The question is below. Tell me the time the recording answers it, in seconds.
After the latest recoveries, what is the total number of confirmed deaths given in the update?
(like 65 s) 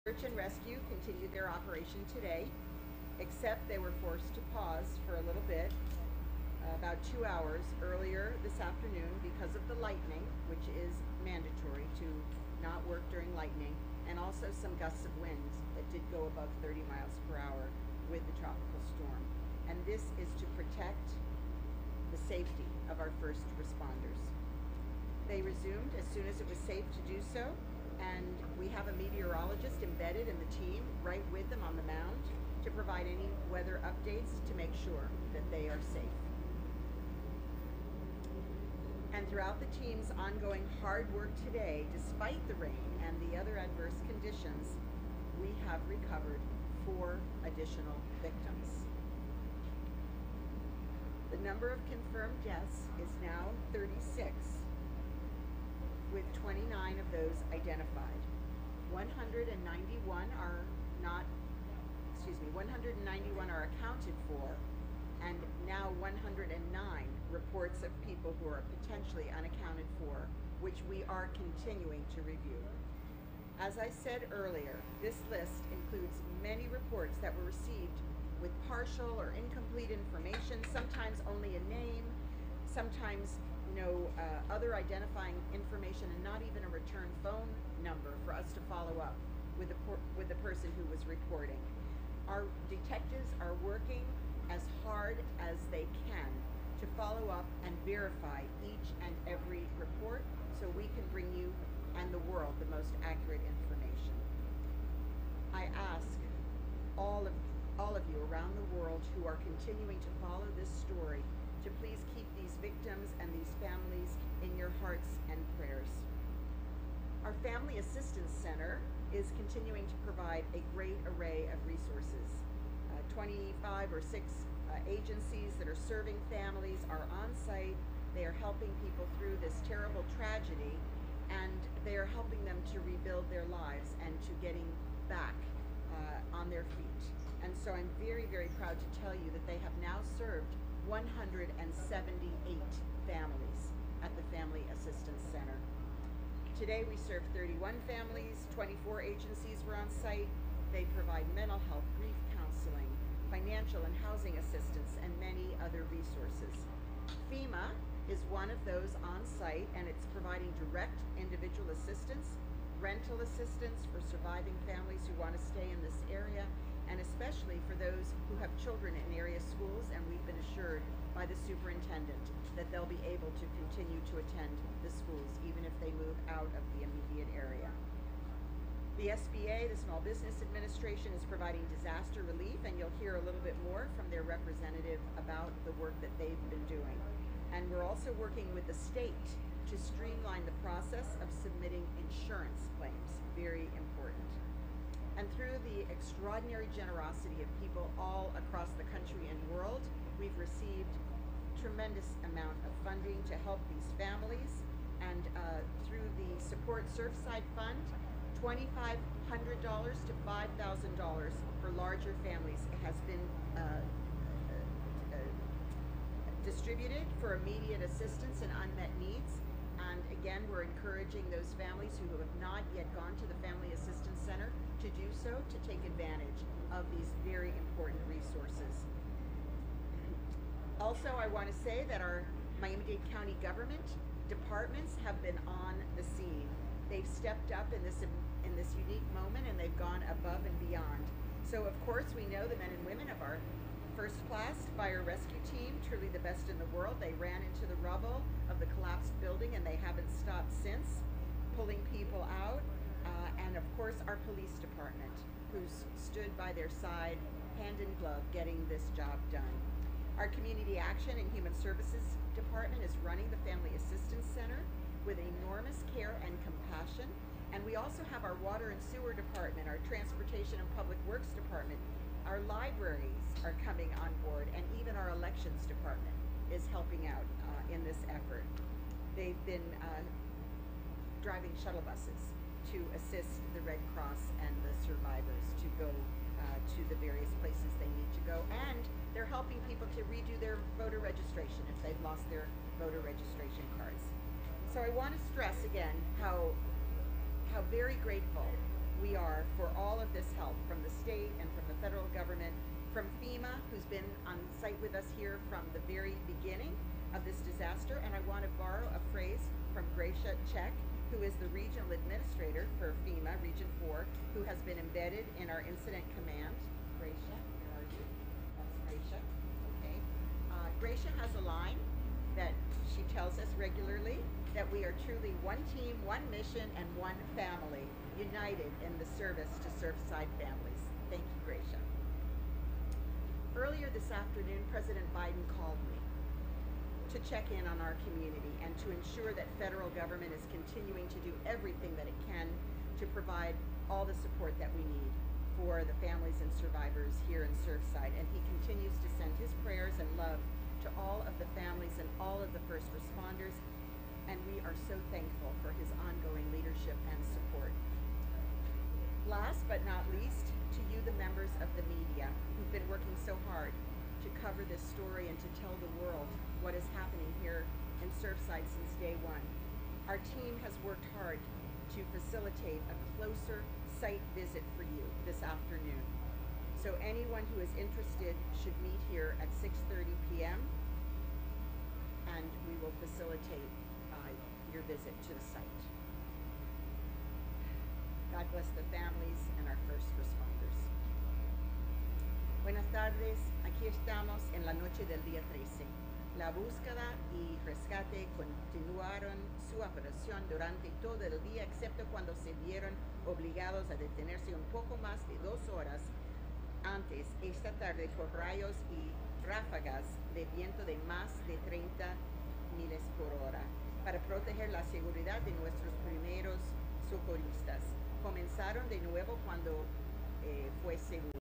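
53 s.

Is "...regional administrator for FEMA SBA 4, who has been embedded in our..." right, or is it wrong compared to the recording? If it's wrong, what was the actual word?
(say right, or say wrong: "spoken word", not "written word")
wrong: "Region", not "SBA".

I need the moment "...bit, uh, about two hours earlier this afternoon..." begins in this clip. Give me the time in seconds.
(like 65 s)
5 s.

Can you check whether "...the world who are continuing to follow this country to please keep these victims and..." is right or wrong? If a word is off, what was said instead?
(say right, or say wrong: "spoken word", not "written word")
wrong: "story", not "country".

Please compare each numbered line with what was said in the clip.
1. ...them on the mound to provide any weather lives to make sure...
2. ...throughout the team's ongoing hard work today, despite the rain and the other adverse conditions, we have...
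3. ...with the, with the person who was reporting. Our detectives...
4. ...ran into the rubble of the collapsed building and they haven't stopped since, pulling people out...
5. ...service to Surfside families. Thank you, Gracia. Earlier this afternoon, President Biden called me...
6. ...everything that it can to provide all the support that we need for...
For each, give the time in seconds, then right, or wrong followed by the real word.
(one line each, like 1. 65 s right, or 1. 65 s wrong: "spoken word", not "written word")
1. 31 s wrong: "updates", not "lives"
2. 39 s right
3. 89 s right
4. 247 s right
5. 329 s right
6. 341 s right.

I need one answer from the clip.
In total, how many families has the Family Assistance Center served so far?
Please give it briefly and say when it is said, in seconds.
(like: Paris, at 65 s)
178, at 140 s.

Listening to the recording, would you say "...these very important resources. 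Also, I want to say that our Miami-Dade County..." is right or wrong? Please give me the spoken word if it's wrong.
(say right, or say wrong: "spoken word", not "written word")
right.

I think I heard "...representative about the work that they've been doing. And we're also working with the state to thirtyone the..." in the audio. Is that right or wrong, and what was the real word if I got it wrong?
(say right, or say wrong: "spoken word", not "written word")
wrong: "streamline", not "thirtyone".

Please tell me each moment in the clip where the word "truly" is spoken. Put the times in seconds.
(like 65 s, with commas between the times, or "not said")
245 s, 325 s.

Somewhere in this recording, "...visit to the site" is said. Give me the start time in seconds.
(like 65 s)
384 s.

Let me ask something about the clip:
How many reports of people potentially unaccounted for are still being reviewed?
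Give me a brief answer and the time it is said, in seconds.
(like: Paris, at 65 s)
109, at 66 s.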